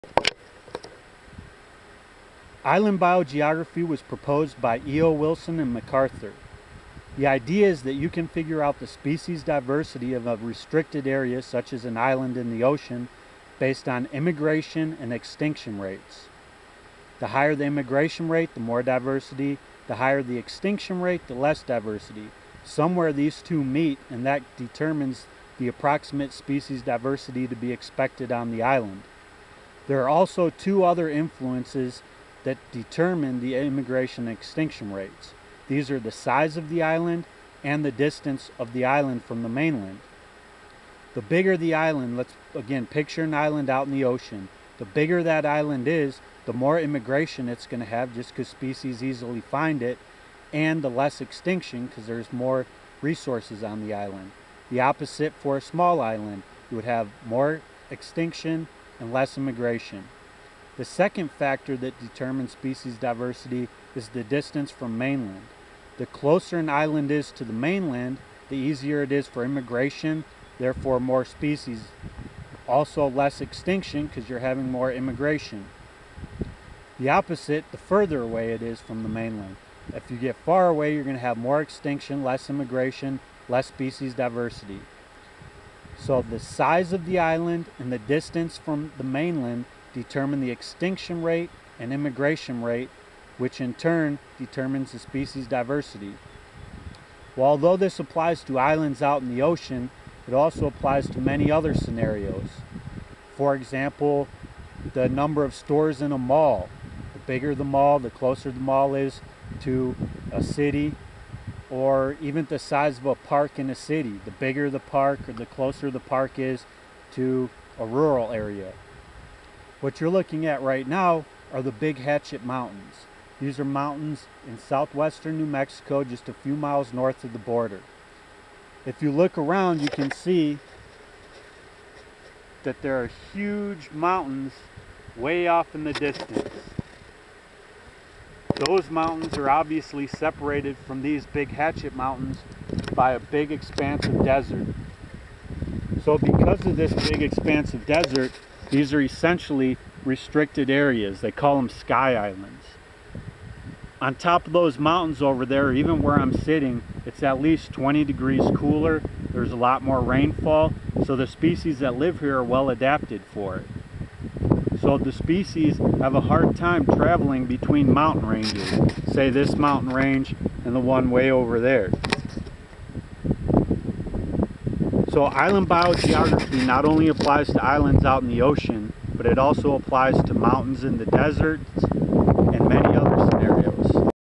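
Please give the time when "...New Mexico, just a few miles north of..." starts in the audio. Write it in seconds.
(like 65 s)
125 s.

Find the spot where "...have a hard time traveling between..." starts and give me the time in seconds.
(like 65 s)
165 s.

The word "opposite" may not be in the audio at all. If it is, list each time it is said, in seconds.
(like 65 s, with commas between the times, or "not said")
54 s, 77 s.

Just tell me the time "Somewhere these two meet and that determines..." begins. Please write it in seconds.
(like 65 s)
22 s.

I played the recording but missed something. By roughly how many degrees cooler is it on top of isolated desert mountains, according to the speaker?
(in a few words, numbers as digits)
20 degrees.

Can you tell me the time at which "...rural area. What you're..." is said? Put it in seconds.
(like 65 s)
117 s.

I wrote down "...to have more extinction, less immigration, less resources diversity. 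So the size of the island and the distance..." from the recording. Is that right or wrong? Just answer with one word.
wrong.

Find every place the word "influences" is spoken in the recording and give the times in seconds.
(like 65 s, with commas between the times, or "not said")
31 s.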